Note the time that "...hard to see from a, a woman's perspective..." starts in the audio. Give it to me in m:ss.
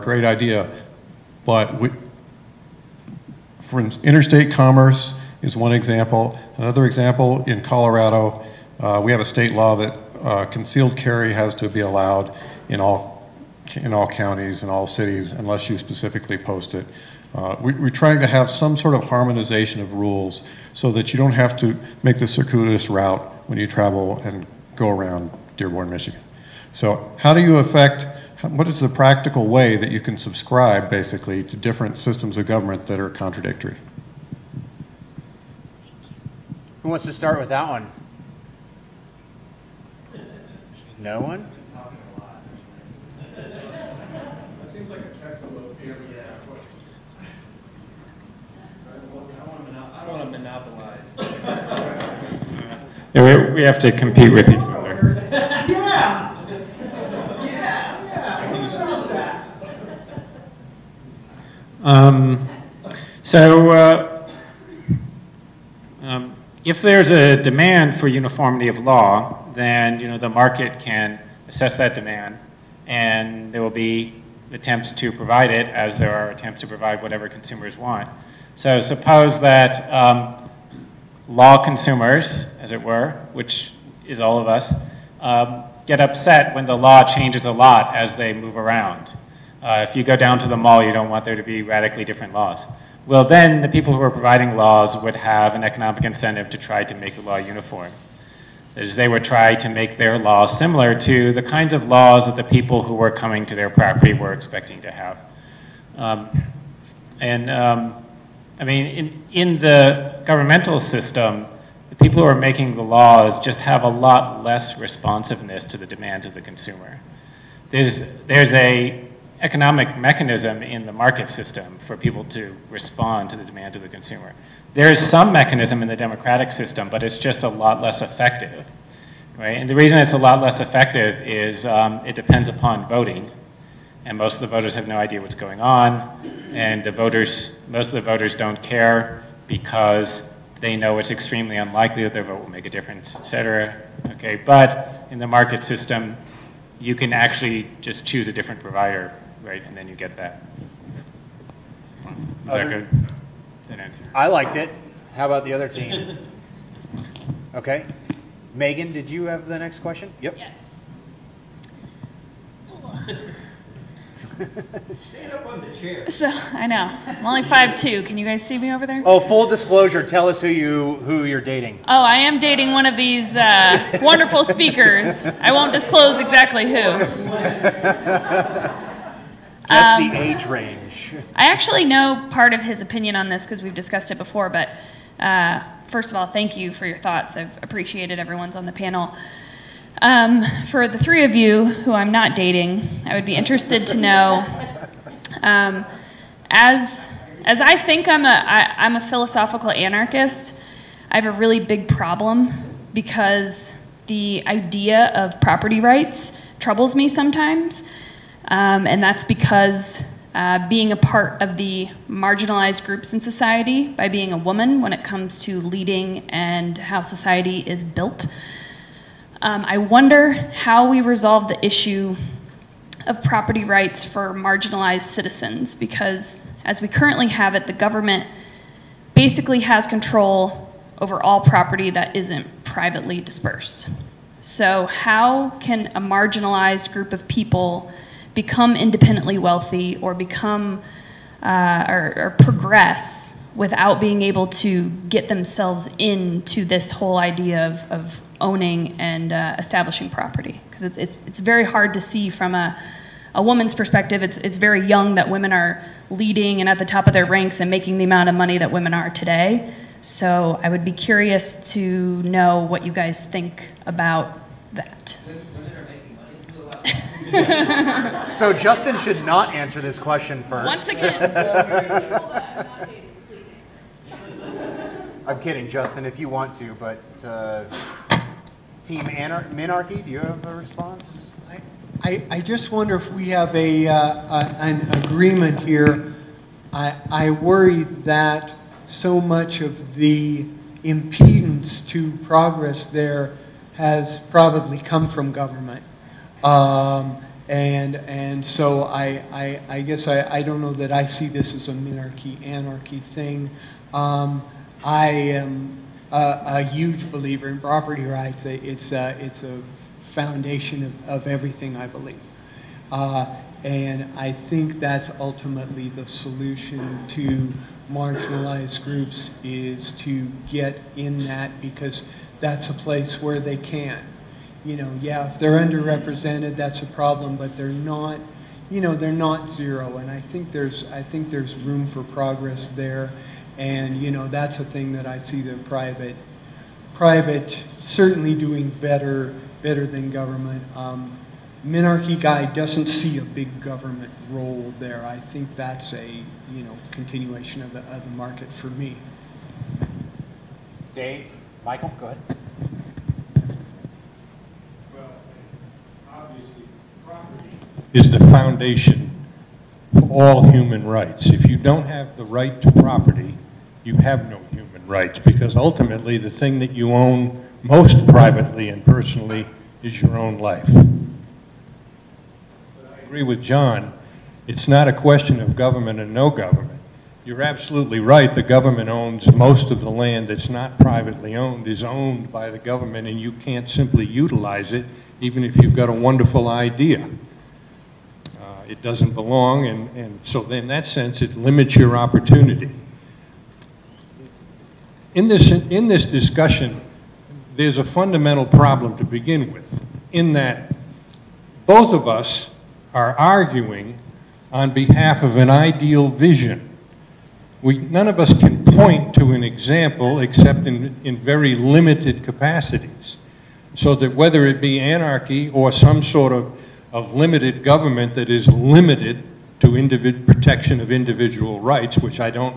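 4:11.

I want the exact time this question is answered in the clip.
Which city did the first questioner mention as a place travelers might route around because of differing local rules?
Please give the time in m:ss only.
0:25.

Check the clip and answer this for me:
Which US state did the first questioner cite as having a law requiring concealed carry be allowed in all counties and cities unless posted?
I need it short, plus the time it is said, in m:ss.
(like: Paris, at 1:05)
Colorado, at 0:07.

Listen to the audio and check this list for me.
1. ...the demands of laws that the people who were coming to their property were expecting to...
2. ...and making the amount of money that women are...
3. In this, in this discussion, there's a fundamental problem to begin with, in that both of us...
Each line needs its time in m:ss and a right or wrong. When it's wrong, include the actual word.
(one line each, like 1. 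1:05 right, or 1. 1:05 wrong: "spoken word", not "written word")
1. 1:41 wrong: "kinds", not "demands"
2. 4:17 right
3. 6:35 right.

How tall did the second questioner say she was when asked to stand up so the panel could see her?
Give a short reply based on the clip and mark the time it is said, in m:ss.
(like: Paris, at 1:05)
5'2", at 2:47.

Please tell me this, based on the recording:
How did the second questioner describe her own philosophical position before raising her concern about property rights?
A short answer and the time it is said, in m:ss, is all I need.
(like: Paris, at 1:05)
philosophical anarchist, at 3:19.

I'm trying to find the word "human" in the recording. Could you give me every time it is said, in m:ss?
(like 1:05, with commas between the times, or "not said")
6:00, 6:04.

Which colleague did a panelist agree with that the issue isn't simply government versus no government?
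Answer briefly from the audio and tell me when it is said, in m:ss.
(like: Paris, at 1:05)
John, at 6:13.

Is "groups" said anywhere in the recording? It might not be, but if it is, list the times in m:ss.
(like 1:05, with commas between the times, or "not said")
3:32, 3:56, 5:18.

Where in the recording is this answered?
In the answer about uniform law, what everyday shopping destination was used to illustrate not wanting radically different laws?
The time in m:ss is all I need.
1:30.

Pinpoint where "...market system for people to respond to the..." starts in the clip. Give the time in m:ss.
2:00.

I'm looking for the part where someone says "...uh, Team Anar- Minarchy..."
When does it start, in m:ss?
4:37.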